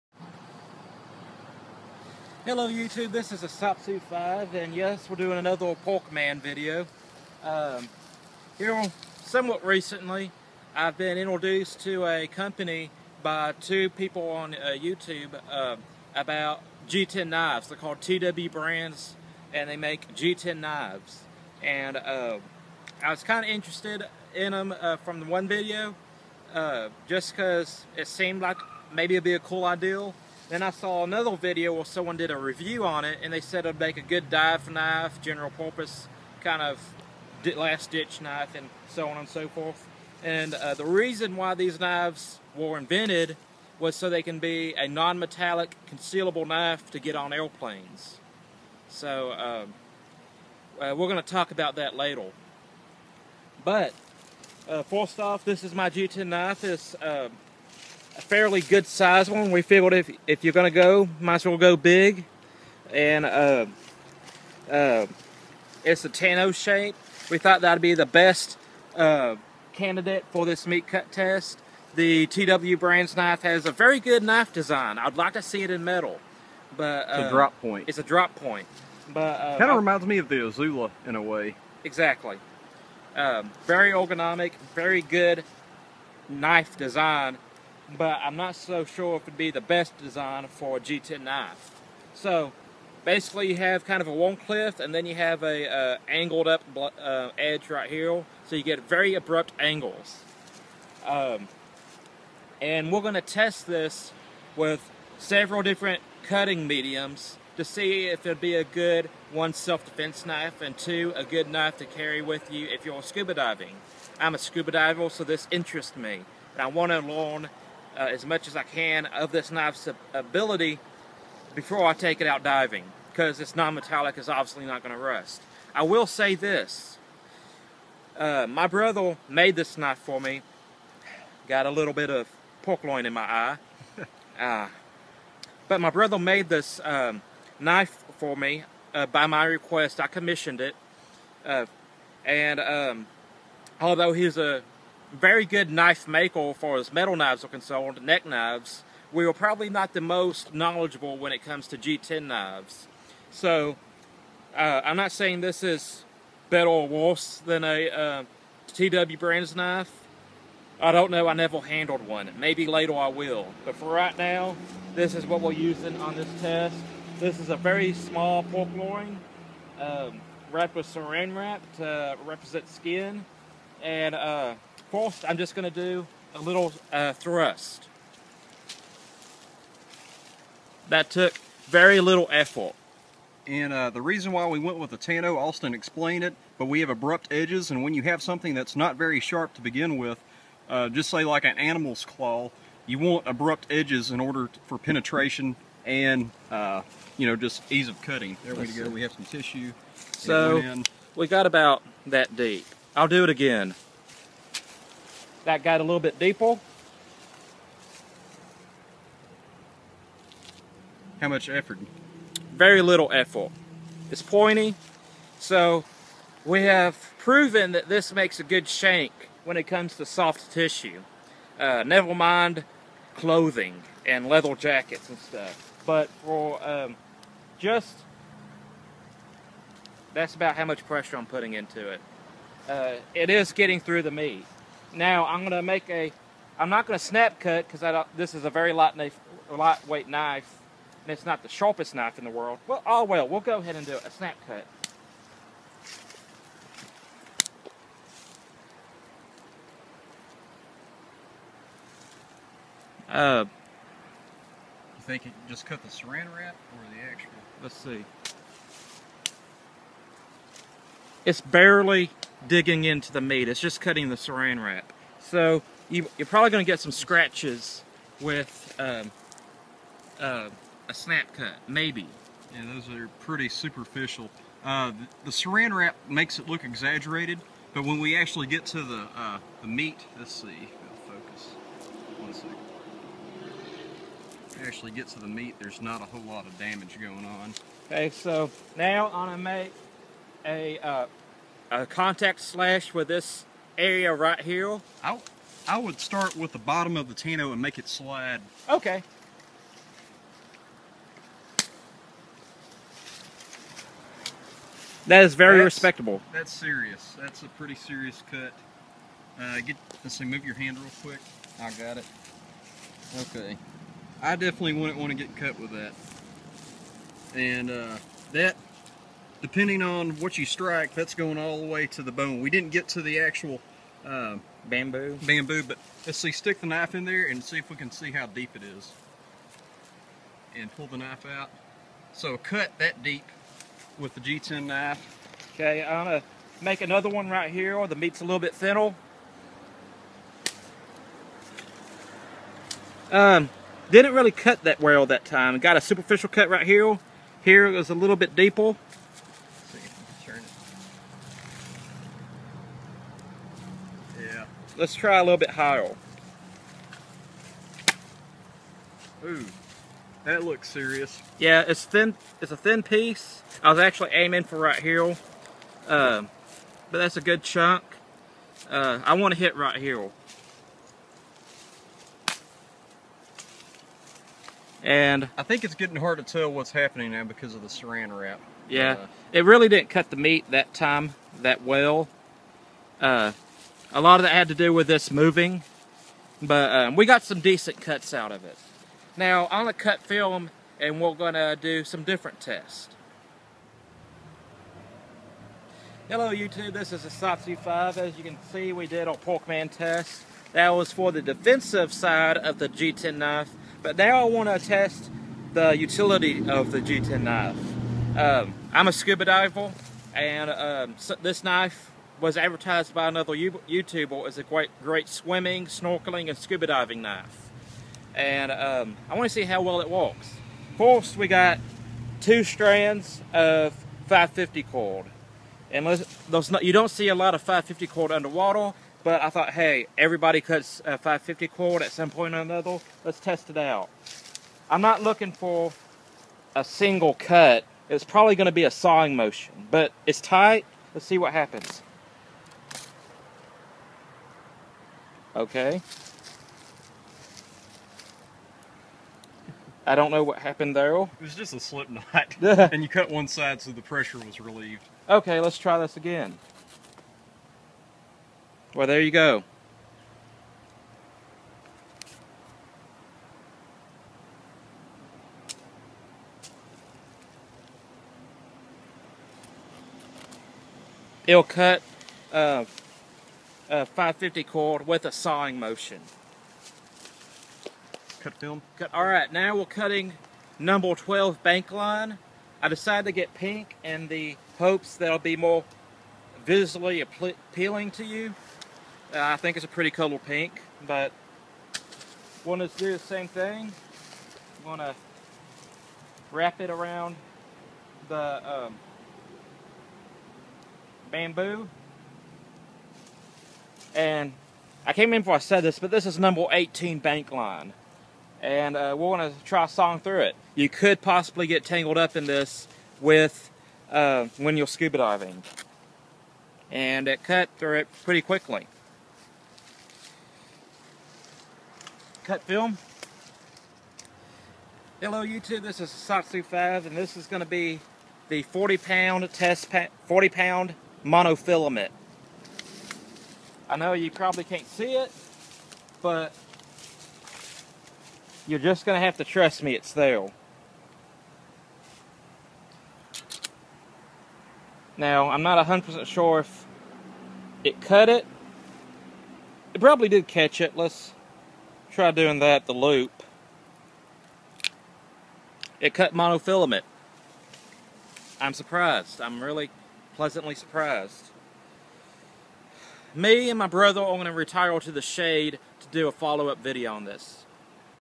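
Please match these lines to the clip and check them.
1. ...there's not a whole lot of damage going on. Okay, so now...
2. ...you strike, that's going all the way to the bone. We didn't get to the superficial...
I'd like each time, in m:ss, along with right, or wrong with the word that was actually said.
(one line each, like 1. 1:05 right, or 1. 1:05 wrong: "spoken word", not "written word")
1. 4:45 right
2. 5:20 wrong: "actual", not "superficial".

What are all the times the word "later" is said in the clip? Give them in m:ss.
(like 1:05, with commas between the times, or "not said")
0:51, 2:42.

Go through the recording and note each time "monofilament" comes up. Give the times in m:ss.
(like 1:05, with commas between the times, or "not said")
8:51, 9:16.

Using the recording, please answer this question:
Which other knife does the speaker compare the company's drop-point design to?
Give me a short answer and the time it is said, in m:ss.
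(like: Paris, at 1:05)
Azula, at 1:20.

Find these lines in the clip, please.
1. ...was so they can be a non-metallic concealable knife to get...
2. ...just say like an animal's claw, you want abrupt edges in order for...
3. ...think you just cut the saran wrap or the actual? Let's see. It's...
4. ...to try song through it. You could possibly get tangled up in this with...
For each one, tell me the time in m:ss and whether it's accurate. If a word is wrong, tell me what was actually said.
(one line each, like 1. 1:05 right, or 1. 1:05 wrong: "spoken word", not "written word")
1. 0:43 right
2. 3:10 right
3. 4:15 right
4. 8:29 right.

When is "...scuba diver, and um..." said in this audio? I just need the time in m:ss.
6:48.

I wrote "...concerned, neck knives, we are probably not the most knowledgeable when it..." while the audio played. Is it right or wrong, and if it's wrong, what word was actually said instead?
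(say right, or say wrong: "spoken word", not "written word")
right.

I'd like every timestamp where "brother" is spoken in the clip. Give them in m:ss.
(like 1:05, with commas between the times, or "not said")
2:08, 2:15, 9:23.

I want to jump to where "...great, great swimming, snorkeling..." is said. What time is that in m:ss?
6:54.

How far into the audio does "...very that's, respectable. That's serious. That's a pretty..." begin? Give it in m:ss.
5:05.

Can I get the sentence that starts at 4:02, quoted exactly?
Well, oh well, we'll go ahead and do a snap cut.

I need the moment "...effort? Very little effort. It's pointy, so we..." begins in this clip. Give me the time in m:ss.
3:31.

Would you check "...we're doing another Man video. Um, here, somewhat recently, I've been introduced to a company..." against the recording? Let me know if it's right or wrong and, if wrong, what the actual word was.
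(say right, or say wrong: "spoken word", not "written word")
right.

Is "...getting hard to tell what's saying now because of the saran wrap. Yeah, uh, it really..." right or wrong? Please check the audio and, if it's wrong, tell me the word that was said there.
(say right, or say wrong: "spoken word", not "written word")
wrong: "happening", not "saying".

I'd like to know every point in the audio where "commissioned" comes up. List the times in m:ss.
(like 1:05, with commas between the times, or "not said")
2:20.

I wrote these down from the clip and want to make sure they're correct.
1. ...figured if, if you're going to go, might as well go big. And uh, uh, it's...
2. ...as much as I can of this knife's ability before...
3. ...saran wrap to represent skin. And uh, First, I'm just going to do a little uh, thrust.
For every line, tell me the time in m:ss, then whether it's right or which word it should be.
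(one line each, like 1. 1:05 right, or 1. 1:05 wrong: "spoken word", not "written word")
1. 0:59 right
2. 1:58 right
3. 2:50 right.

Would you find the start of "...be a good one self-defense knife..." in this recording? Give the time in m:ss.
1:48.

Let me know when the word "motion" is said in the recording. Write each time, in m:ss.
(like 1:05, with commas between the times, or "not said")
7:19, 7:55.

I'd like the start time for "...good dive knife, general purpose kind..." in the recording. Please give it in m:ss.
0:34.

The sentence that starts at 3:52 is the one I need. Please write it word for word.
Uh, it is getting through the meat.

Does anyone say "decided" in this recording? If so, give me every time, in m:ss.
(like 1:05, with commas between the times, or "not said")
8:02.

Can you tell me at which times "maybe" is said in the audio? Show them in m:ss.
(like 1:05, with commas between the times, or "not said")
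0:28, 2:42, 4:31.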